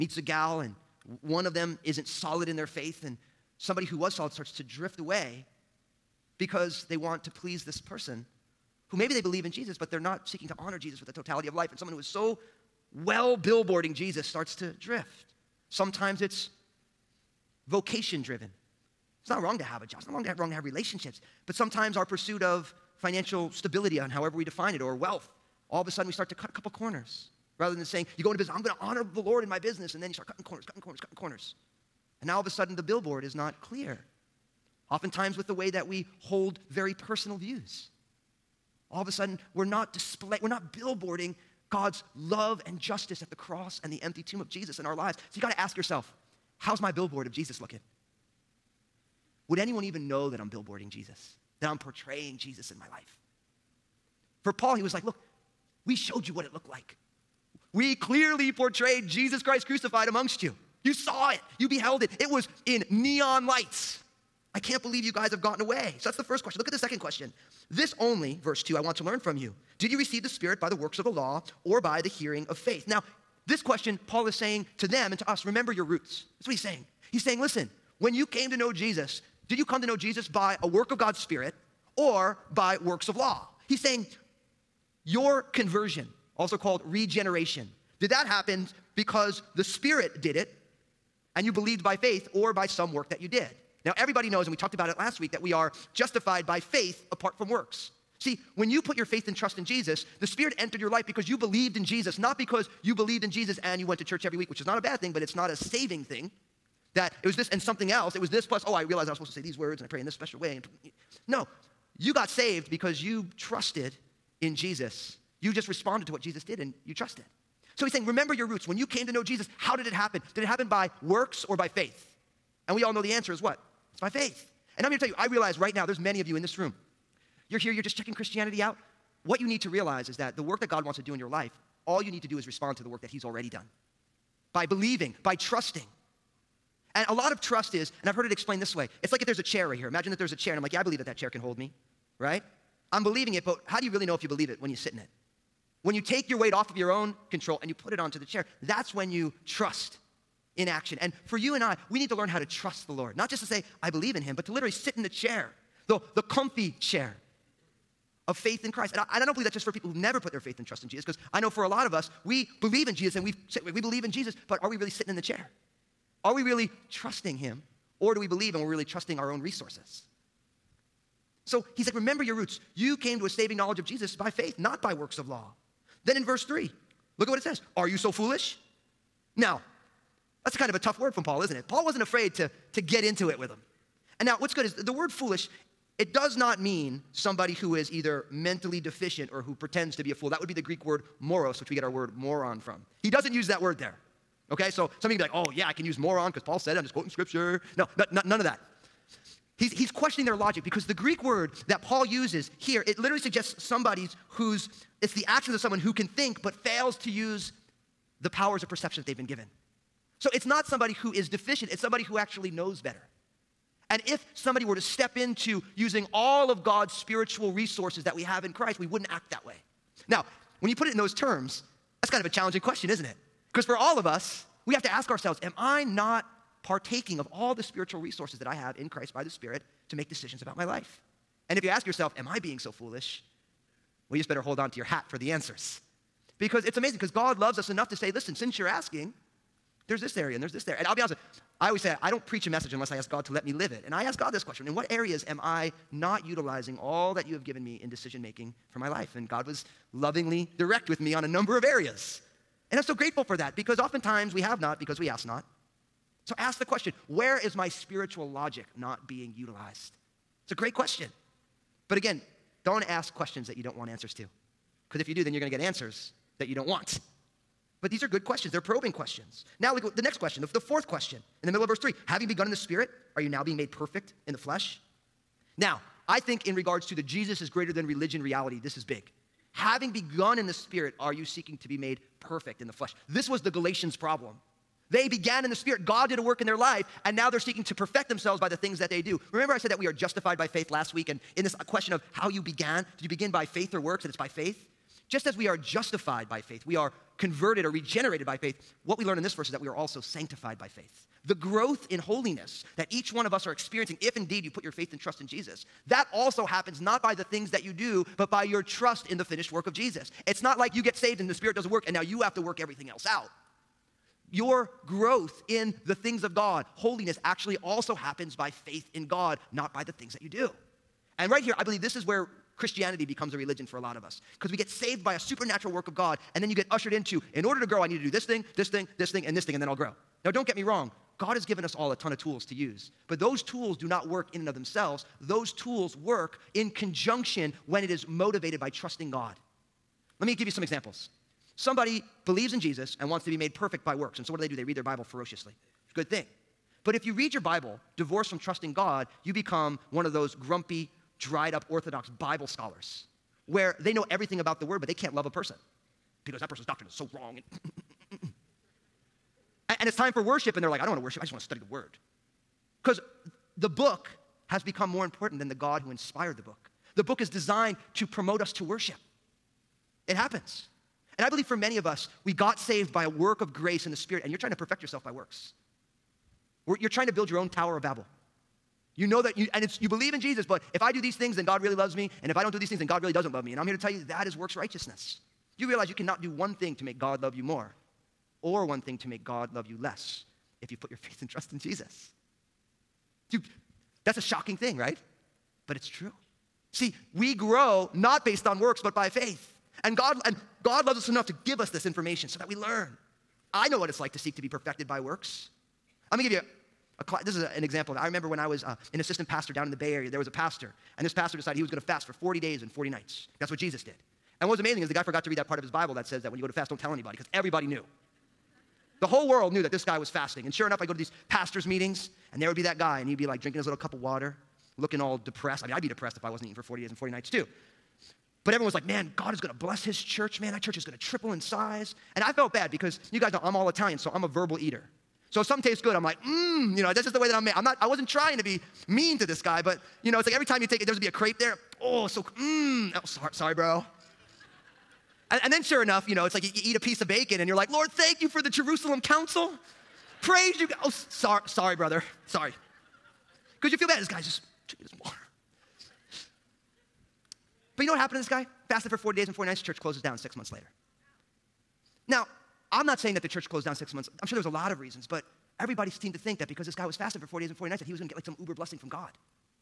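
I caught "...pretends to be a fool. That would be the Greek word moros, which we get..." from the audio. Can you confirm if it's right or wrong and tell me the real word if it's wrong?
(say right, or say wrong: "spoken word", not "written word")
right.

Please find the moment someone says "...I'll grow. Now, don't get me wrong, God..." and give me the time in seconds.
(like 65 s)
329 s.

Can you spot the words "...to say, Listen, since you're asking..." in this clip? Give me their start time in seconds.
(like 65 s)
237 s.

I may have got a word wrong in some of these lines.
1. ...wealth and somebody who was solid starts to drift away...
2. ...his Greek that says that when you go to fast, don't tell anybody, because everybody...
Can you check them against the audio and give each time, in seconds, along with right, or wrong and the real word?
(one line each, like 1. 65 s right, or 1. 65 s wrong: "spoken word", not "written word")
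1. 2 s wrong: "faith", not "wealth"
2. 415 s wrong: "Bible", not "Greek".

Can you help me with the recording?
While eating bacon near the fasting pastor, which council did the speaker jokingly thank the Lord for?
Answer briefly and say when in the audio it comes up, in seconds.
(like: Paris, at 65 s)
Jerusalem council, at 448 s.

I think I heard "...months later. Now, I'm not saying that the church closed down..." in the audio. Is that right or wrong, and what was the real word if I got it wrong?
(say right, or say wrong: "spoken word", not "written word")
right.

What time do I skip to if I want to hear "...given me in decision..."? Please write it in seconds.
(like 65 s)
247 s.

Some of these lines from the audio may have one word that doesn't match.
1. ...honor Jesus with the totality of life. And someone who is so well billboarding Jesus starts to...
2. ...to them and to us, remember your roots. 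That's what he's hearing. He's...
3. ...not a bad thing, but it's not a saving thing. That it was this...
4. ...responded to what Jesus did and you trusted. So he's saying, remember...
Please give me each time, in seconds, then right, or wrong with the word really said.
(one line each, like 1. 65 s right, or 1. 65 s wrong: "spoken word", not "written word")
1. 10 s right
2. 74 s wrong: "saying", not "hearing"
3. 104 s right
4. 115 s right.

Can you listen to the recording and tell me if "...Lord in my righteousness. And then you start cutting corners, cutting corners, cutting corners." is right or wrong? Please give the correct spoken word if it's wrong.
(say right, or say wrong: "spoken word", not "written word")
wrong: "business", not "righteousness".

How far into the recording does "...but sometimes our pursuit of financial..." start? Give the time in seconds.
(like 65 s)
21 s.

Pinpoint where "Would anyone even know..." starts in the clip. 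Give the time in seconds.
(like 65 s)
49 s.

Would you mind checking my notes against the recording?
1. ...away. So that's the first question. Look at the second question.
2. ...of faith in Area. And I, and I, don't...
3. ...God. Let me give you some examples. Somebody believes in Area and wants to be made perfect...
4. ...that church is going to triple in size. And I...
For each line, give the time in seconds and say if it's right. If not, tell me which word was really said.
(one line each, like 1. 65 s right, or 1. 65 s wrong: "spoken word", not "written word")
1. 65 s right
2. 158 s wrong: "Christ", not "Area"
3. 339 s wrong: "Jesus", not "Area"
4. 430 s right.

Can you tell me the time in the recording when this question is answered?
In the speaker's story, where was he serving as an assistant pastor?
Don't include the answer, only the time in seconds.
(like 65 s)
409 s.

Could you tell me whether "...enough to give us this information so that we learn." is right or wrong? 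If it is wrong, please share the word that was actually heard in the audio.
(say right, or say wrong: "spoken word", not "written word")
right.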